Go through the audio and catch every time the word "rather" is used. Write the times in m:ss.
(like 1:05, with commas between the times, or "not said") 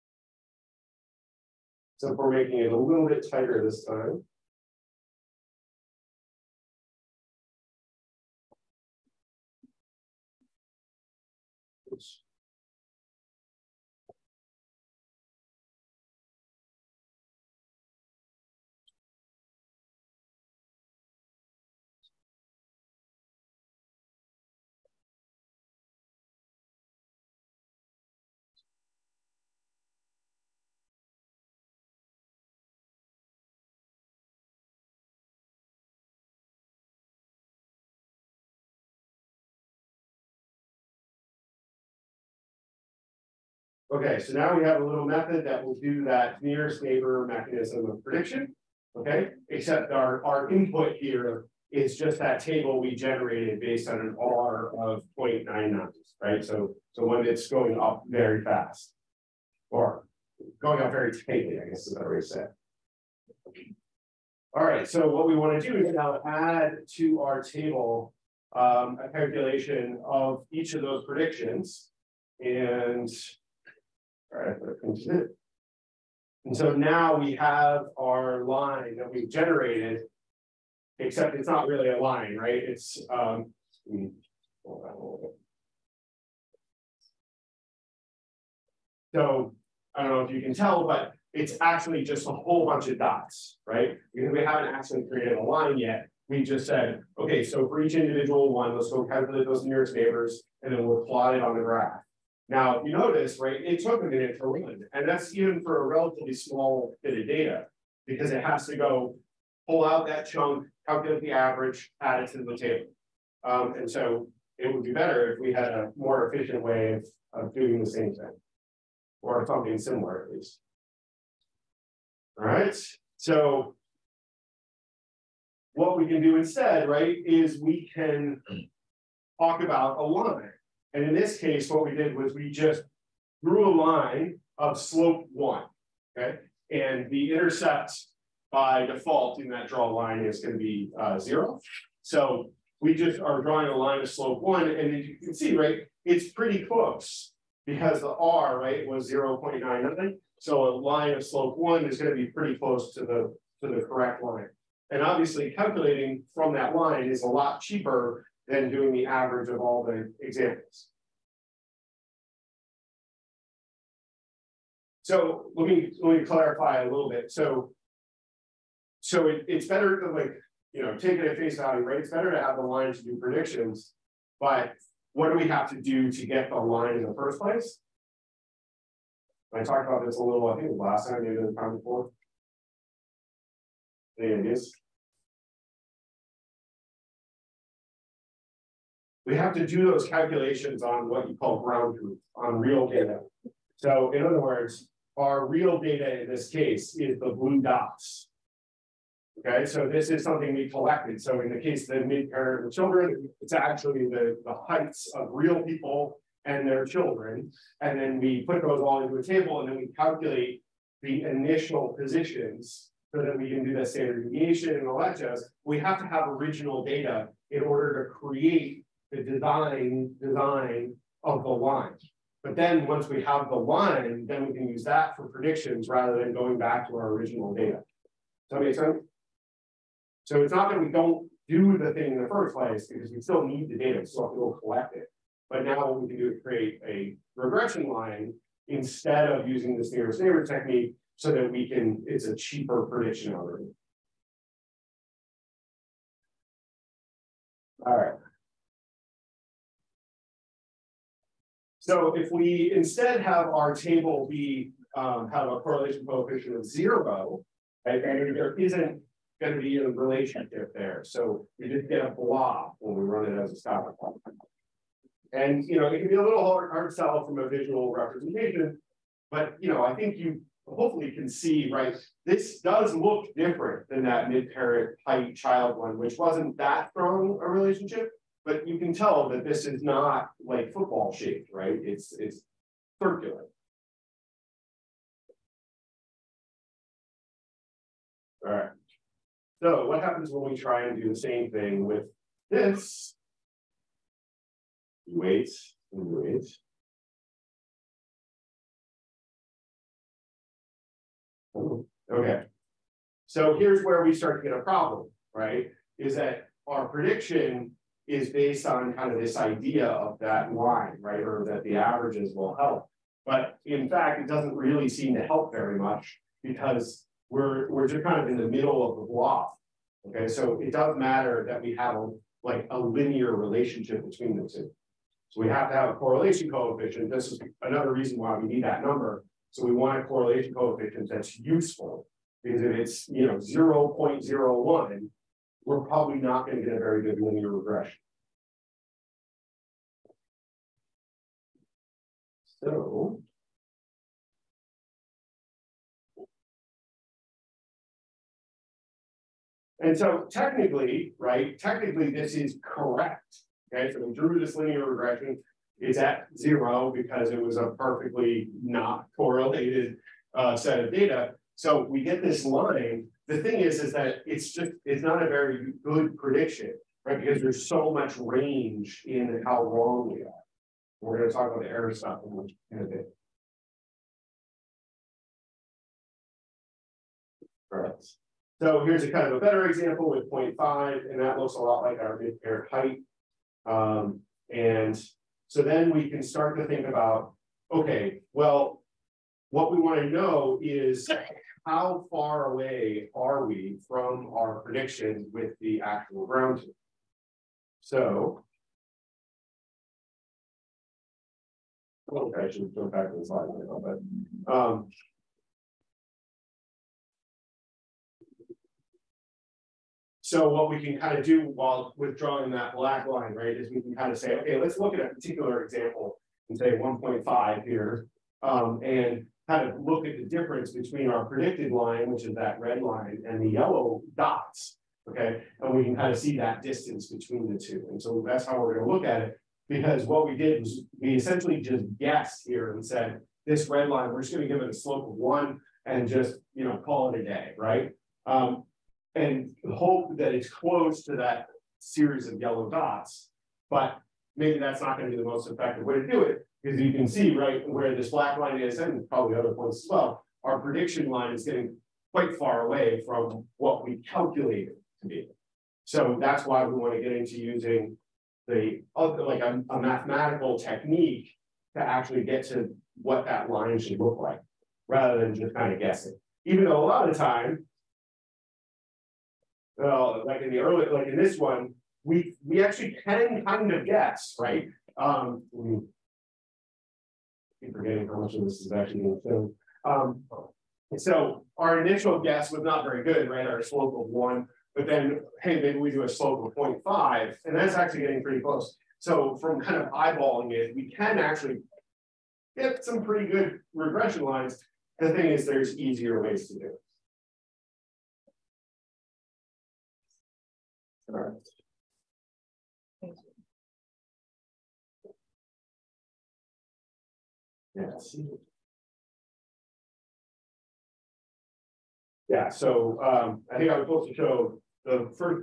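3:45, 7:44.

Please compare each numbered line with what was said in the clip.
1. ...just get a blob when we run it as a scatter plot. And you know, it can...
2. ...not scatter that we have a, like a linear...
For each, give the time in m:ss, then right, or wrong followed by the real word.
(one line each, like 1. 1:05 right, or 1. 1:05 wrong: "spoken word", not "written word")
1. 4:21 right
2. 5:20 wrong: "matter", not "scatter".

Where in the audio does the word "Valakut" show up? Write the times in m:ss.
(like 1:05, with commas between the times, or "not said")
not said.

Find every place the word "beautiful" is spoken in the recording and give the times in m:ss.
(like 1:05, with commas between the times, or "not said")
not said.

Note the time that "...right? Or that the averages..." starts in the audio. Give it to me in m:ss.
5:11.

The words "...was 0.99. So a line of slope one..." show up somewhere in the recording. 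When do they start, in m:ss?
2:28.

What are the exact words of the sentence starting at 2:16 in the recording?
And the intercept by default in that draw line is gonna be uh, zero.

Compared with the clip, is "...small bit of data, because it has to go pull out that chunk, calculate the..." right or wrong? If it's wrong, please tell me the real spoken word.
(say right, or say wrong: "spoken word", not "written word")
right.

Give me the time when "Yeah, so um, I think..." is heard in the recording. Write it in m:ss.
8:32.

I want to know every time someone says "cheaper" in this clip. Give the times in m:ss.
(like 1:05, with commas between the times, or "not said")
2:37, 4:02.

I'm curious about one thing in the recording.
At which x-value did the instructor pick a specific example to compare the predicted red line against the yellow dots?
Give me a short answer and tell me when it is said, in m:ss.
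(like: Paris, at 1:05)
1.5, at 6:56.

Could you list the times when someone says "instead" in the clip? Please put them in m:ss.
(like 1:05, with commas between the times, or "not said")
2:06, 3:58, 4:12.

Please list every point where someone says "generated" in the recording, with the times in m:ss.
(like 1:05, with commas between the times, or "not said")
0:52, 1:19.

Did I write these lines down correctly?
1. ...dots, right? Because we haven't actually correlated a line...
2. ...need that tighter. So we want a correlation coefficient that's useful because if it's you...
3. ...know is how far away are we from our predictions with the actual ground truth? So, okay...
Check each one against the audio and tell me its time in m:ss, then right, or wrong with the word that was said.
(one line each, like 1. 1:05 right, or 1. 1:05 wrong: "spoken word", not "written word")
1. 1:32 wrong: "created", not "correlated"
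2. 5:28 wrong: "number", not "tighter"
3. 6:30 right.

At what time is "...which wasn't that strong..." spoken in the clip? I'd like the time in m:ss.
4:35.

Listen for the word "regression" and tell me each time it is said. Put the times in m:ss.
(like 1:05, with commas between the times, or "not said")
3:57, 5:37, 5:54, 8:13.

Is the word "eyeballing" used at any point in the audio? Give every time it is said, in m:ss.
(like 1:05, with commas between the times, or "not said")
8:09.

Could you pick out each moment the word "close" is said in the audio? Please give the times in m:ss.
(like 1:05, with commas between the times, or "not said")
2:26, 2:32, 7:20, 8:08.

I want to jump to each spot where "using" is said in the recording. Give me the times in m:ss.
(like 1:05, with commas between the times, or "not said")
3:59, 7:37.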